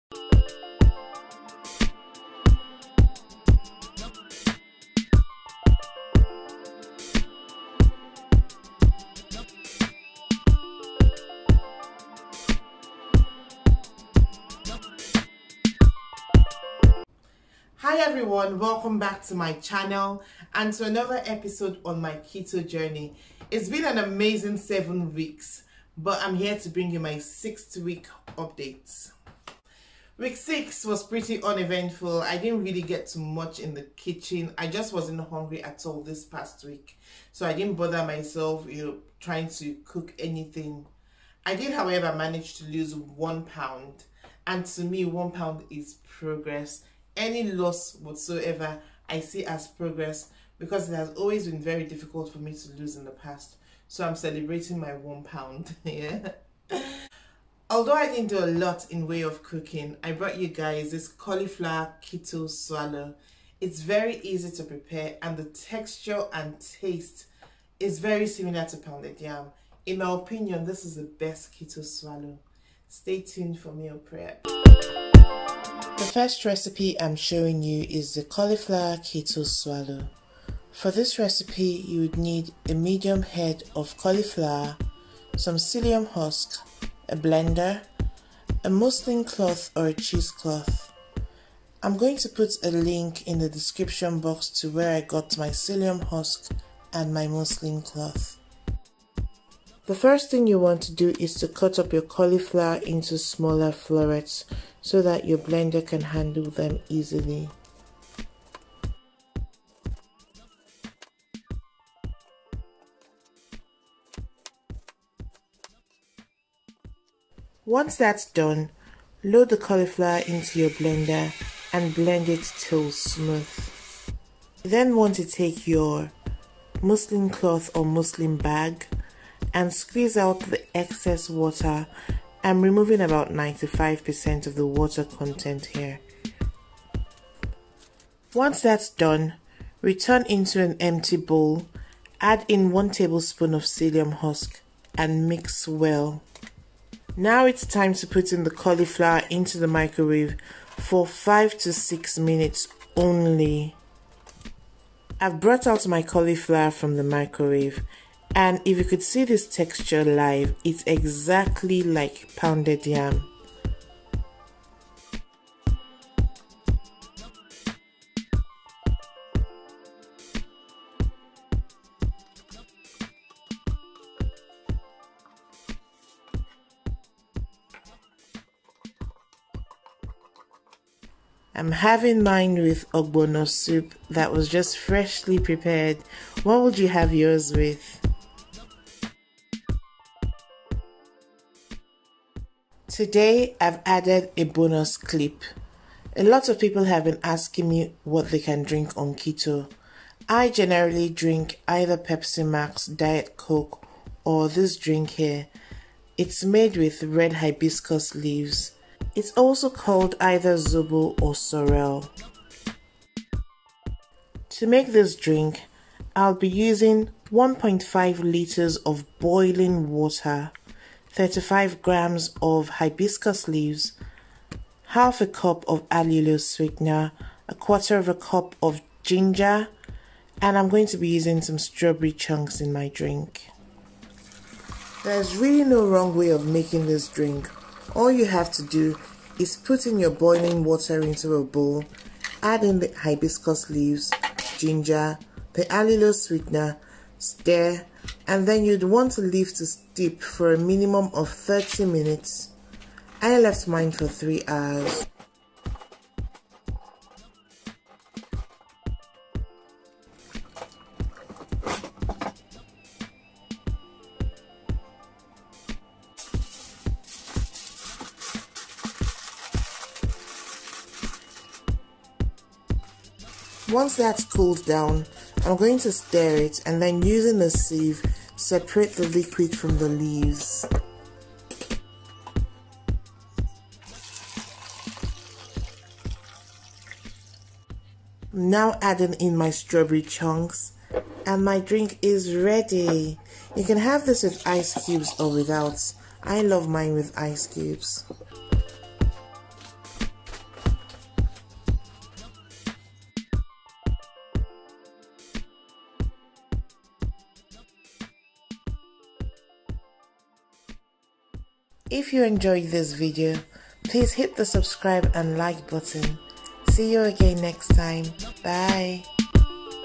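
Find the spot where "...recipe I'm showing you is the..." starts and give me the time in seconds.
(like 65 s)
76 s.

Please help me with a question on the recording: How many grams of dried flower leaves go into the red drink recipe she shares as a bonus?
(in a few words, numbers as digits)
35 grams.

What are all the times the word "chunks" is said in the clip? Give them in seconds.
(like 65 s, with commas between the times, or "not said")
232 s, 290 s.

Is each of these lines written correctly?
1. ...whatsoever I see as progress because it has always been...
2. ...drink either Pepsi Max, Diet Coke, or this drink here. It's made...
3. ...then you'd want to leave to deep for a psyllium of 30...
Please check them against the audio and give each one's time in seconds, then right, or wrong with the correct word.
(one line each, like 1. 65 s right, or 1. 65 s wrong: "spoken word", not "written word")
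1. 47 s right
2. 201 s right
3. 248 s wrong: "minimum", not "psyllium".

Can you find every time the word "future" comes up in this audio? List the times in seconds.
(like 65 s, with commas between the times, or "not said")
not said.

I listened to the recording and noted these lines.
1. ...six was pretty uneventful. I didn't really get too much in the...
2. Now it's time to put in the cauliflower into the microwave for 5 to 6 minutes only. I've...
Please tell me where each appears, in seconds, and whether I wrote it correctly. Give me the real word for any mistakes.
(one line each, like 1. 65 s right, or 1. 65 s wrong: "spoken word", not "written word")
1. 30 s right
2. 147 s right.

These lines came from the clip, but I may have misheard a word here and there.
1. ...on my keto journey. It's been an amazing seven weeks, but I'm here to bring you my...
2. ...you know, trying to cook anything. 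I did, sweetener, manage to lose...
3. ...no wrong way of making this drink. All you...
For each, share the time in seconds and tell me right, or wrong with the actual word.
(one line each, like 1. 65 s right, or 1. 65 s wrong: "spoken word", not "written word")
1. 21 s right
2. 38 s wrong: "however", not "sweetener"
3. 235 s right.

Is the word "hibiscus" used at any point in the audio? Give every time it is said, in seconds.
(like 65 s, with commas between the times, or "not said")
207 s, 222 s, 242 s.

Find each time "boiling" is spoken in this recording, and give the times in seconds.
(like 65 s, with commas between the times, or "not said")
219 s, 240 s.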